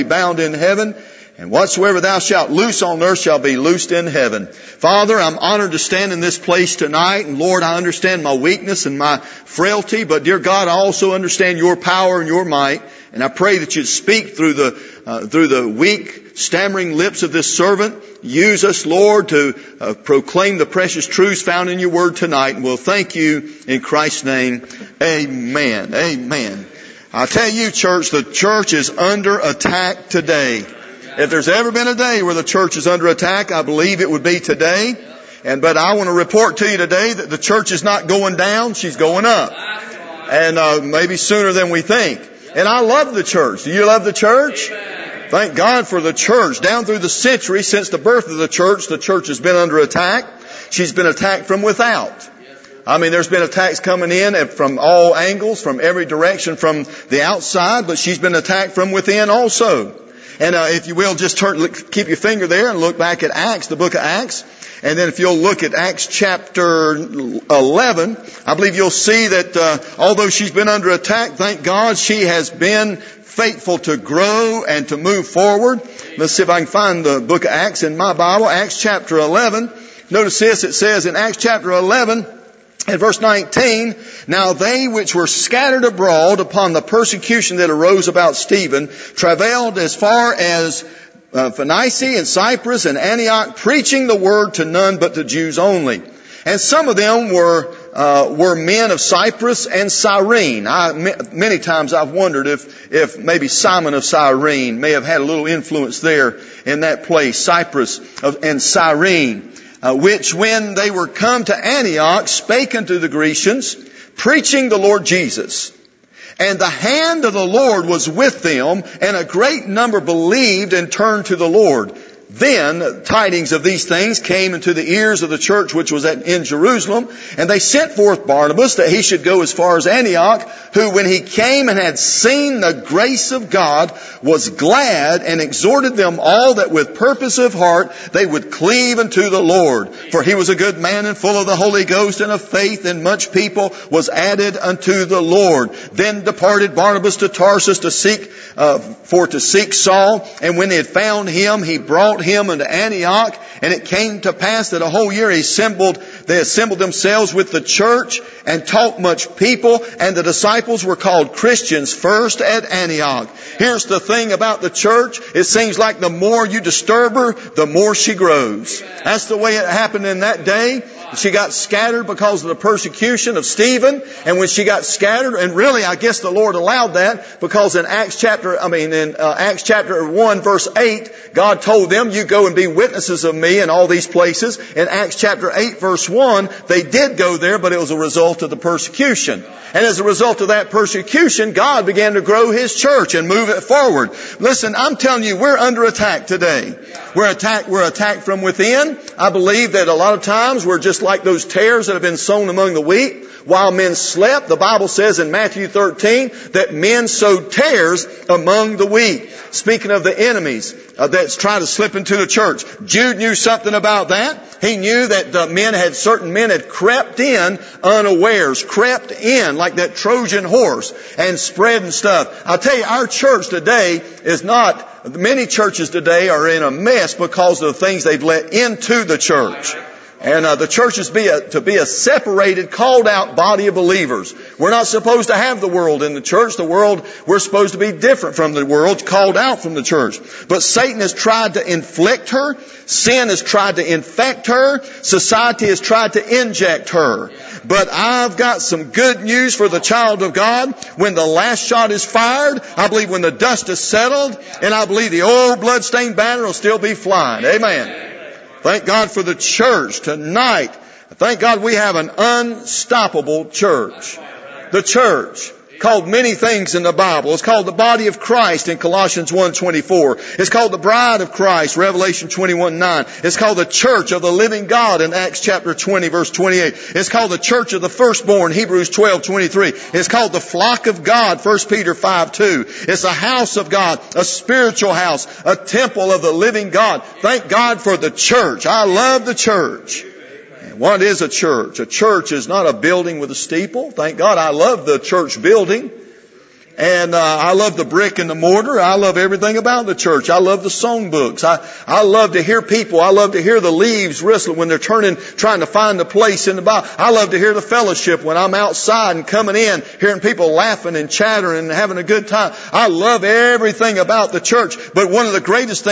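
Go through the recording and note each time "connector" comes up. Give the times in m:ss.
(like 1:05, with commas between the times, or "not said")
not said.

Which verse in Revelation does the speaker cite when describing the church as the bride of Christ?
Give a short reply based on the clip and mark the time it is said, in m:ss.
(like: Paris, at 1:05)
Revelation 21:9, at 4:31.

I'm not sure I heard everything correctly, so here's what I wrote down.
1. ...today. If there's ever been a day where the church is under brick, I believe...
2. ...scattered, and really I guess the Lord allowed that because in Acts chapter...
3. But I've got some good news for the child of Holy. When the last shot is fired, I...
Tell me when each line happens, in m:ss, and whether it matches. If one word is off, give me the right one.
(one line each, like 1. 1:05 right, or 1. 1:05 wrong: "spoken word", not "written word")
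1. 0:30 wrong: "attack", not "brick"
2. 2:54 right
3. 4:07 wrong: "God", not "Holy".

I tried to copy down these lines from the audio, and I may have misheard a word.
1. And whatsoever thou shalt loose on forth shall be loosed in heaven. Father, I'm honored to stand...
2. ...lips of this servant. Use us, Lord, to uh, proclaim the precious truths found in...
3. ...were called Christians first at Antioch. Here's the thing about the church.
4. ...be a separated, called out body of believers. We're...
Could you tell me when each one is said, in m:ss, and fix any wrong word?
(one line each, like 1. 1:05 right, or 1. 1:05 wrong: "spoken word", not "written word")
1. 0:01 wrong: "earth", not "forth"
2. 0:16 right
3. 2:40 right
4. 3:51 right.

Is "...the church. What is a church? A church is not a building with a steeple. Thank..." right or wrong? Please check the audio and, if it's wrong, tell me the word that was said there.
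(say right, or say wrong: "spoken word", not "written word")
right.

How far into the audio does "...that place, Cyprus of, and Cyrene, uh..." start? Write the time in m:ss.
1:46.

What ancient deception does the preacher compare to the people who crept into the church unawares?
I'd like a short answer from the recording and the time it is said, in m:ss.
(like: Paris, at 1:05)
Trojan horse, at 3:39.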